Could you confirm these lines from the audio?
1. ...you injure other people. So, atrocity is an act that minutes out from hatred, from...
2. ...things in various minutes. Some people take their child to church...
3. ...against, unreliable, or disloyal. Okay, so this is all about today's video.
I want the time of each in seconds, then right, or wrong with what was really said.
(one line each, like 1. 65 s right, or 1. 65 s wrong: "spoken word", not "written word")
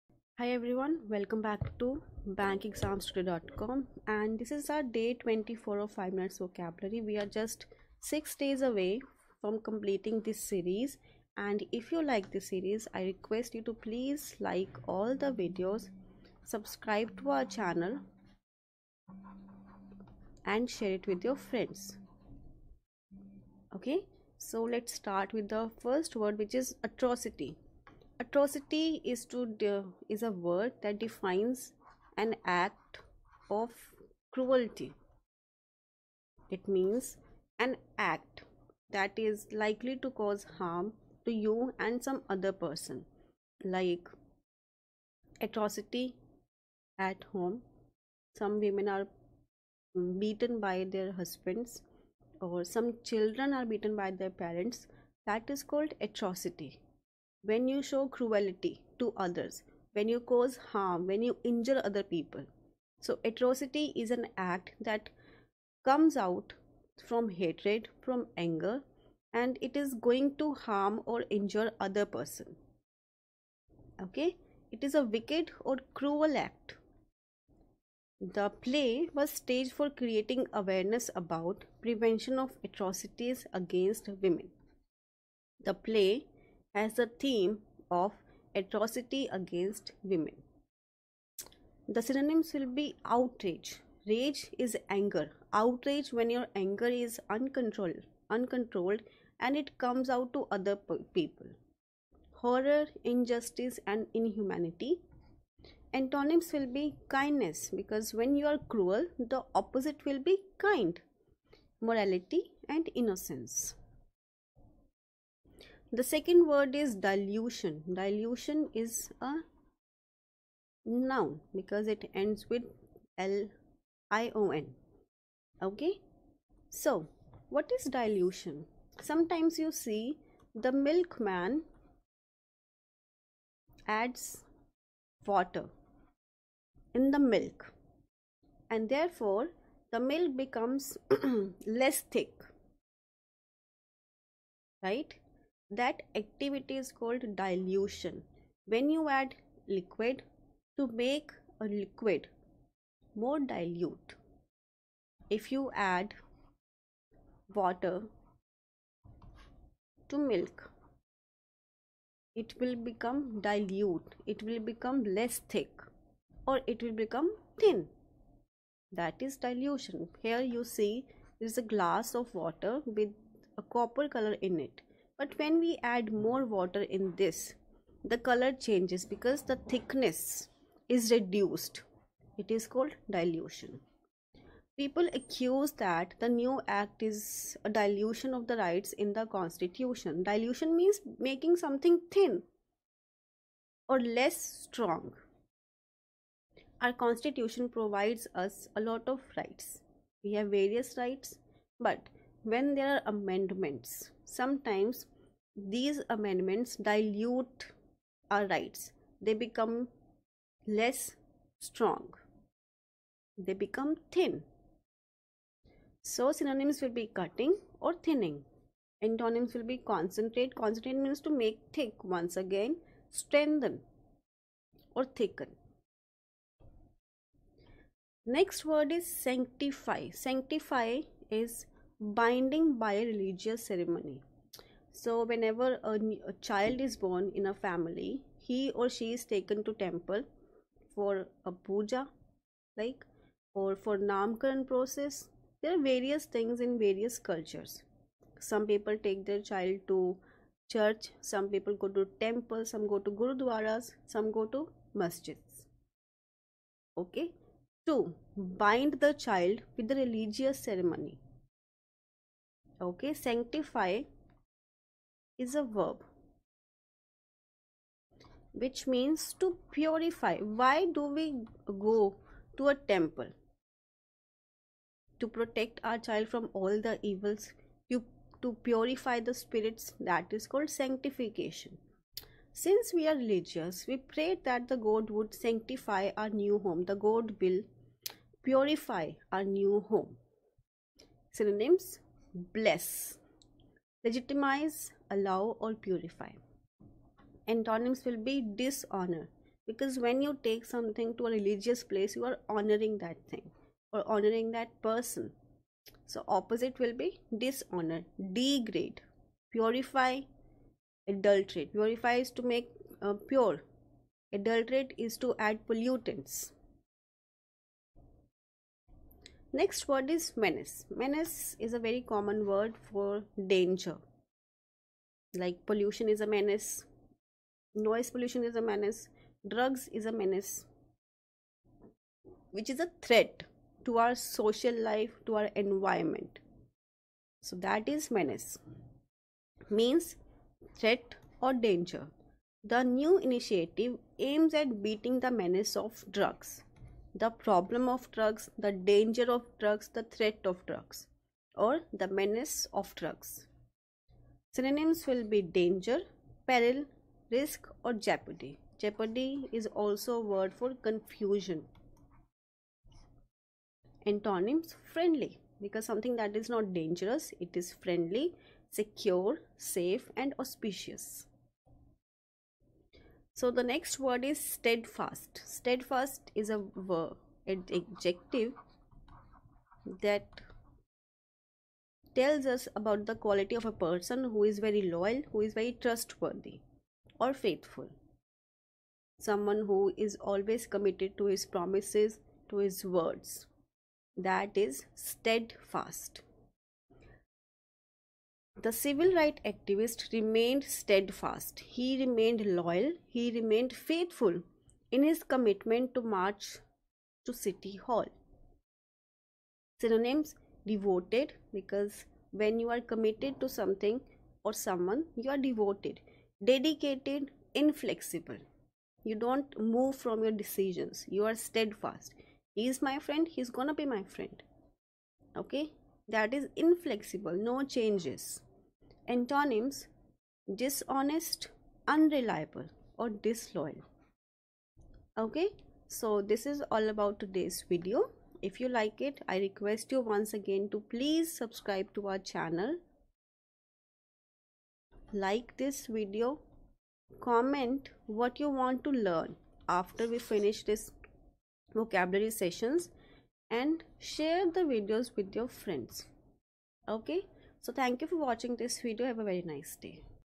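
1. 61 s wrong: "comes", not "minutes"
2. 246 s wrong: "cultures", not "minutes"
3. 430 s wrong: "dishonest", not "against".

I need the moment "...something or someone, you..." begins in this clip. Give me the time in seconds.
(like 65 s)
413 s.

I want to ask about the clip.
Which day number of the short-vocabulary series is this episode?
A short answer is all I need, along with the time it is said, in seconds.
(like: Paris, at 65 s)
24, at 5 s.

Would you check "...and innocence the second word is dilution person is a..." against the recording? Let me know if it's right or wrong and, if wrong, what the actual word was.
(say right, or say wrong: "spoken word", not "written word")
wrong: "dilution", not "person".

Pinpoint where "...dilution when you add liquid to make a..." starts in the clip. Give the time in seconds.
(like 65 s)
147 s.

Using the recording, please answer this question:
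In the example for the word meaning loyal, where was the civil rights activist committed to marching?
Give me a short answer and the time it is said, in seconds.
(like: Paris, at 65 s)
City Hall, at 407 s.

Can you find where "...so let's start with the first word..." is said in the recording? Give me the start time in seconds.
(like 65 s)
24 s.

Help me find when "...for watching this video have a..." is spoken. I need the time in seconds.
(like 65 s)
458 s.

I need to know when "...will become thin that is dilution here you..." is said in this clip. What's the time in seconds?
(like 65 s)
166 s.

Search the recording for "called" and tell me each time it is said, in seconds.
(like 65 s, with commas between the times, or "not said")
55 s, 146 s, 182 s, 280 s.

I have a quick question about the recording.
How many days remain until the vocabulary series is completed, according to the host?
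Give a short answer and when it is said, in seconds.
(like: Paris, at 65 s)
6, at 7 s.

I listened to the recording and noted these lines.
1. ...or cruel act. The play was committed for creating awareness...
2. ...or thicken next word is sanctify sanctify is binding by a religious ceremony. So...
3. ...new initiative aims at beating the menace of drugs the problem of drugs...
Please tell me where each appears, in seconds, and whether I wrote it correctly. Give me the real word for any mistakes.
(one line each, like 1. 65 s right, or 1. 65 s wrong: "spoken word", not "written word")
1. 75 s wrong: "staged", not "committed"
2. 224 s right
3. 342 s right.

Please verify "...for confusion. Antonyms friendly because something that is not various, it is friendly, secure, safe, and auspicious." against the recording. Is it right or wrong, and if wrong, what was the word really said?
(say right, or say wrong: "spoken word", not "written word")
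wrong: "dangerous", not "various".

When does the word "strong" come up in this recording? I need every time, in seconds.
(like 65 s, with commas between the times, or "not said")
194 s, 211 s.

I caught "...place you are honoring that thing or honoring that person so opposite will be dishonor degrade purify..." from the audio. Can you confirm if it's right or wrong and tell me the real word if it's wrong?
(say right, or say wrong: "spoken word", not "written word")
right.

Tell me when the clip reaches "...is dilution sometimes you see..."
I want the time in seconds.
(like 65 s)
127 s.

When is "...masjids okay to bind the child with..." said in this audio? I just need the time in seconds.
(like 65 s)
254 s.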